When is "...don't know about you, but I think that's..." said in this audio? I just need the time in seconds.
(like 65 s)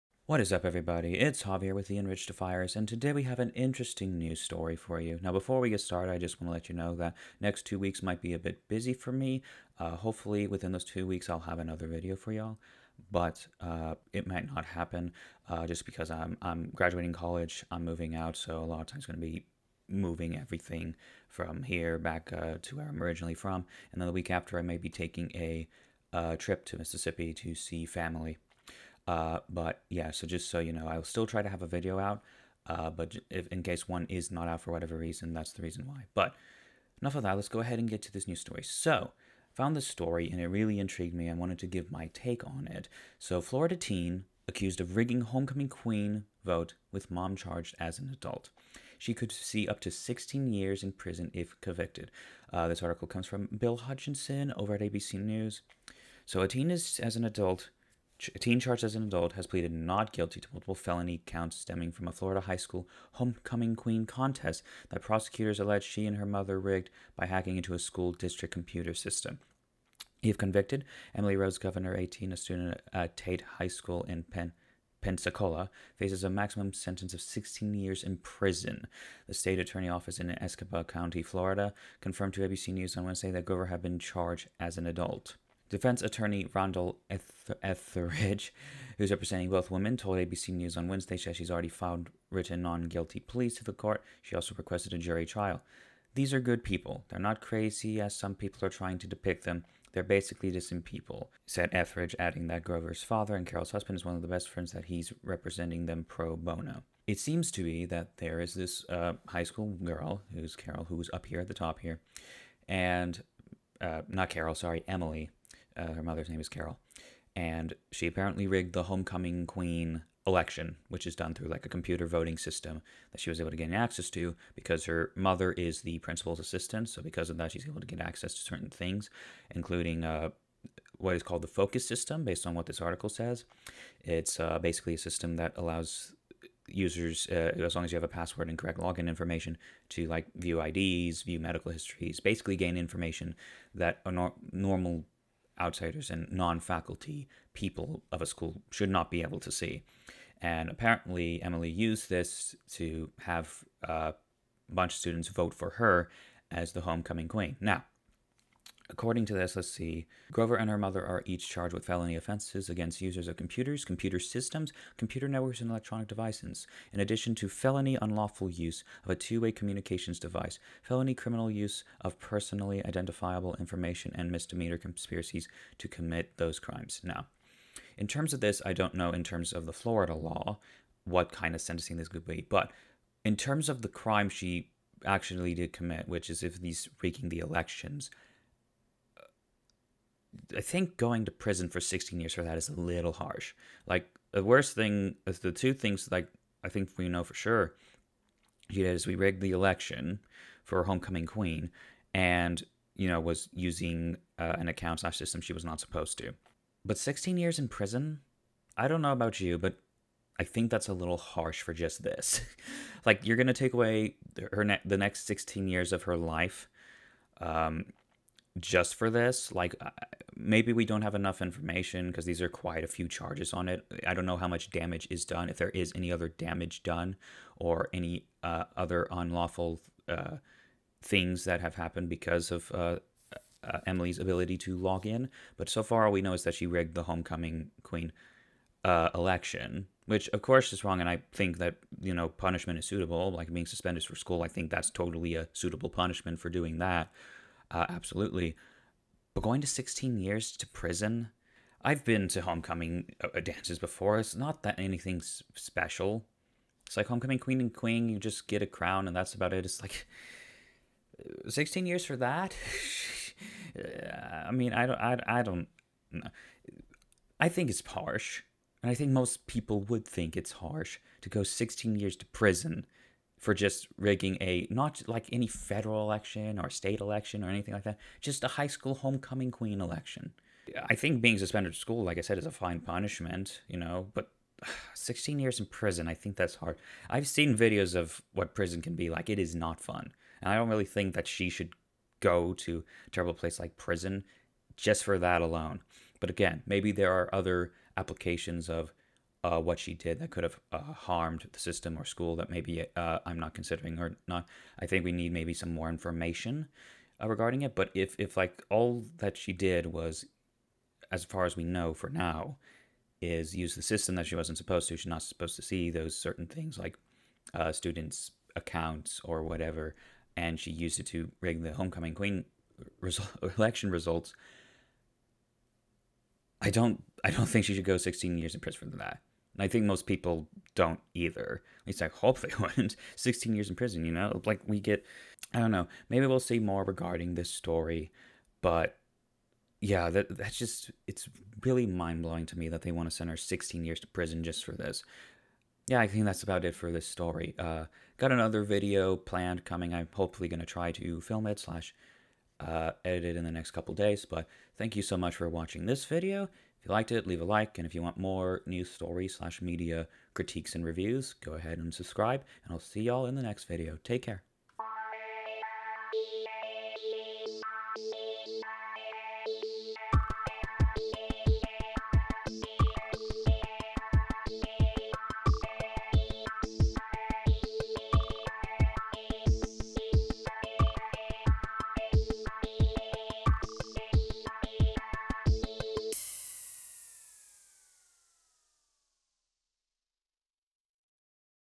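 208 s.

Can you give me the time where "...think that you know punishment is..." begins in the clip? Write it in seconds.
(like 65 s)
241 s.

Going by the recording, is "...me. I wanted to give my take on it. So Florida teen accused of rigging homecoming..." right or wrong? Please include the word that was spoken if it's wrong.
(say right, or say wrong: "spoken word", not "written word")
right.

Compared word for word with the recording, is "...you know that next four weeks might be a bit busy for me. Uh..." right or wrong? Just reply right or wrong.
wrong.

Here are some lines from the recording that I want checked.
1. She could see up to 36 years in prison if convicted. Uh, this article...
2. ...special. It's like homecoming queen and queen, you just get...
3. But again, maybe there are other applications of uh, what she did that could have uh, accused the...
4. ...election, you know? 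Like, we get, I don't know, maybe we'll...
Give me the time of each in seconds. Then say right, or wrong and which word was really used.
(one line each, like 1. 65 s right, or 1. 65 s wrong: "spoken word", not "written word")
1. 48 s wrong: "16", not "36"
2. 255 s right
3. 296 s wrong: "harmed", not "accused"
4. 333 s wrong: "prison", not "election".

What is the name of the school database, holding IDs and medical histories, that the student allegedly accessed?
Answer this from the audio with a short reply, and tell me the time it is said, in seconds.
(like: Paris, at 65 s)
Focus, at 131 s.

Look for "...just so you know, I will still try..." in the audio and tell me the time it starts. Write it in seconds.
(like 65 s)
30 s.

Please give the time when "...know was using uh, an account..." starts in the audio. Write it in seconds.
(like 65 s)
203 s.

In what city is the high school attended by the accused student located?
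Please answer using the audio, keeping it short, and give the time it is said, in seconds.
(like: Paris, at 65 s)
Pensacola, at 75 s.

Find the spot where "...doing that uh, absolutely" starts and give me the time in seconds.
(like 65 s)
246 s.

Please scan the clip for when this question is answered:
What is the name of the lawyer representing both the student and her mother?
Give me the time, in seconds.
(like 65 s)
86 s.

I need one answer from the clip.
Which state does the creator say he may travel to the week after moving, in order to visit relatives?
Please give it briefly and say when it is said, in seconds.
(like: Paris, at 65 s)
Mississippi, at 26 s.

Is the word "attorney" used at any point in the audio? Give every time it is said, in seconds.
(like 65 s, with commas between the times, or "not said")
79 s, 86 s.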